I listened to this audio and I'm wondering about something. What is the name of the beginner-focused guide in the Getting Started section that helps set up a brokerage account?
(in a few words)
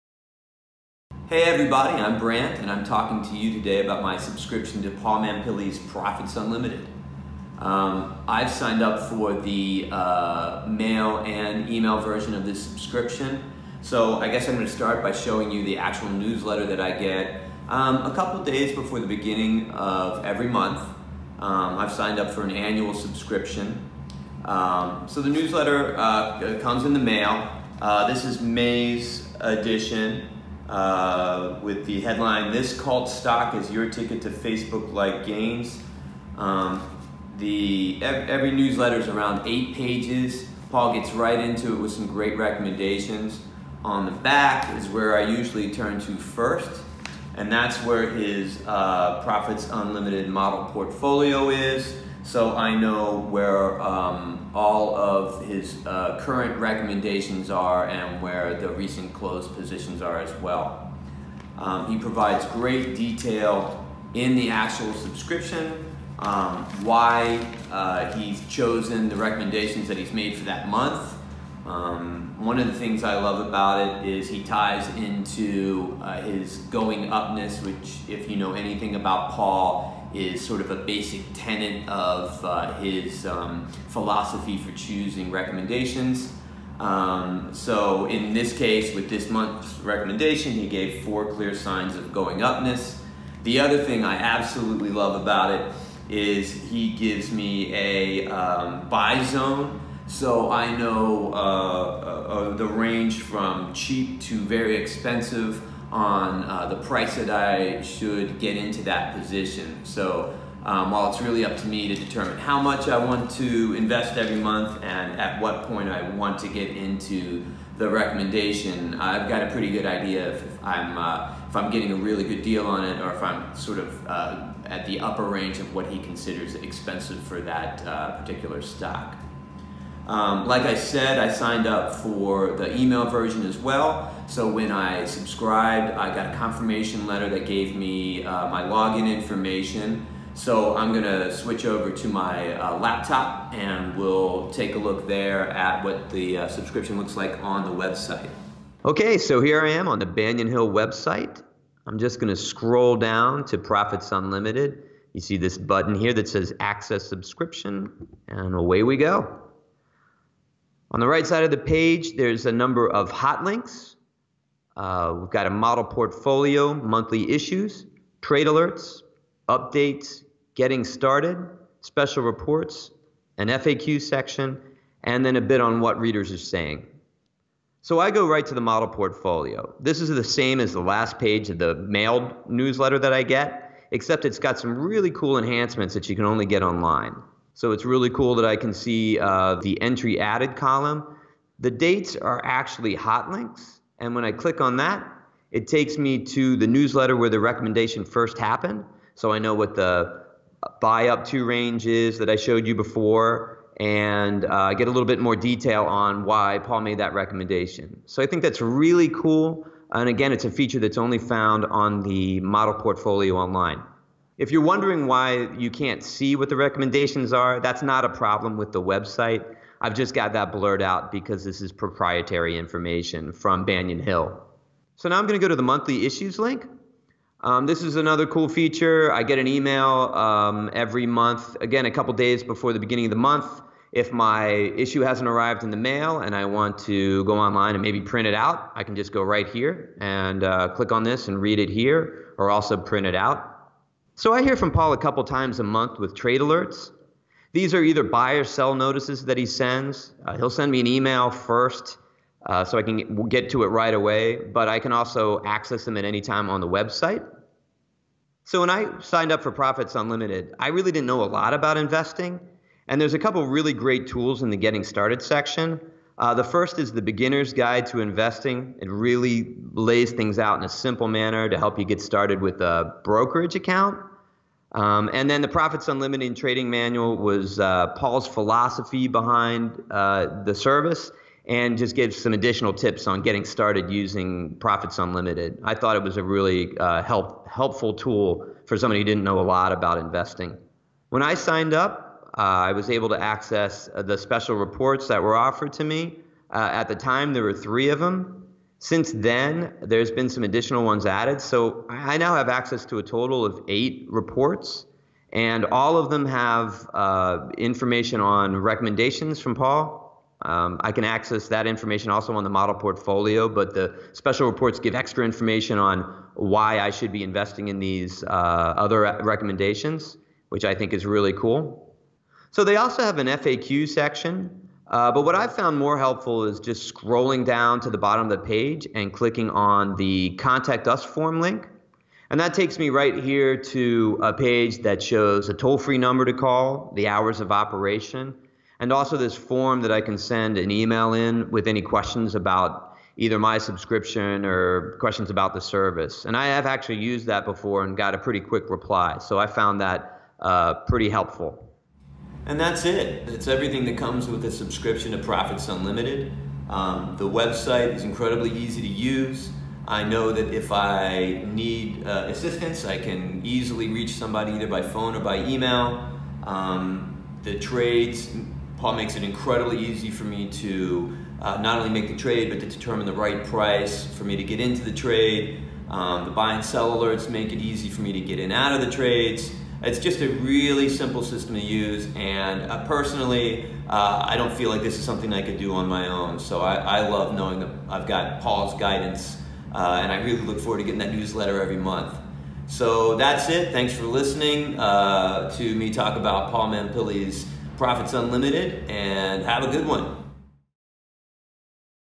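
Beginner's Guide to Investing.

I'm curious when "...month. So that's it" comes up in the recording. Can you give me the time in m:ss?
6:31.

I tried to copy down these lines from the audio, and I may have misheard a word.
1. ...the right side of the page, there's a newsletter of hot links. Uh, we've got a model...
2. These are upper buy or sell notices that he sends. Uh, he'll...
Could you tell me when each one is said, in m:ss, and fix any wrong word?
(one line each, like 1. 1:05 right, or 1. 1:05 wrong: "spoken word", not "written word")
1. 2:40 wrong: "number", not "newsletter"
2. 4:07 wrong: "either", not "upper".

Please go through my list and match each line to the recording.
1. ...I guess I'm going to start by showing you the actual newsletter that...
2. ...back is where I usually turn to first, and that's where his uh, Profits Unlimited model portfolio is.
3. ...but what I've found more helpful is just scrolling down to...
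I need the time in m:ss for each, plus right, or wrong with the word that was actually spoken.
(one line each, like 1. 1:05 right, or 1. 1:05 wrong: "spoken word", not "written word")
1. 0:14 right
2. 0:44 right
3. 5:25 right.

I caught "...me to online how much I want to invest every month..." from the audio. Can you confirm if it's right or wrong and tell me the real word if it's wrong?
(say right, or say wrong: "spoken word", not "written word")
wrong: "determine", not "online".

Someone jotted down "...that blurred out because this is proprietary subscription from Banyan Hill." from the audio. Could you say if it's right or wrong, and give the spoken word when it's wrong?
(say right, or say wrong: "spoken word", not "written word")
wrong: "information", not "subscription".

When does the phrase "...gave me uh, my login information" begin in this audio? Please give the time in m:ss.
2:17.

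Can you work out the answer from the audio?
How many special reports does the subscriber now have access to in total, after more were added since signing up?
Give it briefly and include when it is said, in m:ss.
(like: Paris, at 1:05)
8, at 5:03.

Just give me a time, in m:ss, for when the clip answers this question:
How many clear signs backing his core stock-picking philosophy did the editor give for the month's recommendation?
1:31.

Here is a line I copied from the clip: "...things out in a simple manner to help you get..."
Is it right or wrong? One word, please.
right.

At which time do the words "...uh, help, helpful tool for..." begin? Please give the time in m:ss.
4:46.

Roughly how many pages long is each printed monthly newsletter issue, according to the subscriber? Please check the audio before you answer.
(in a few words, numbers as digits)
8.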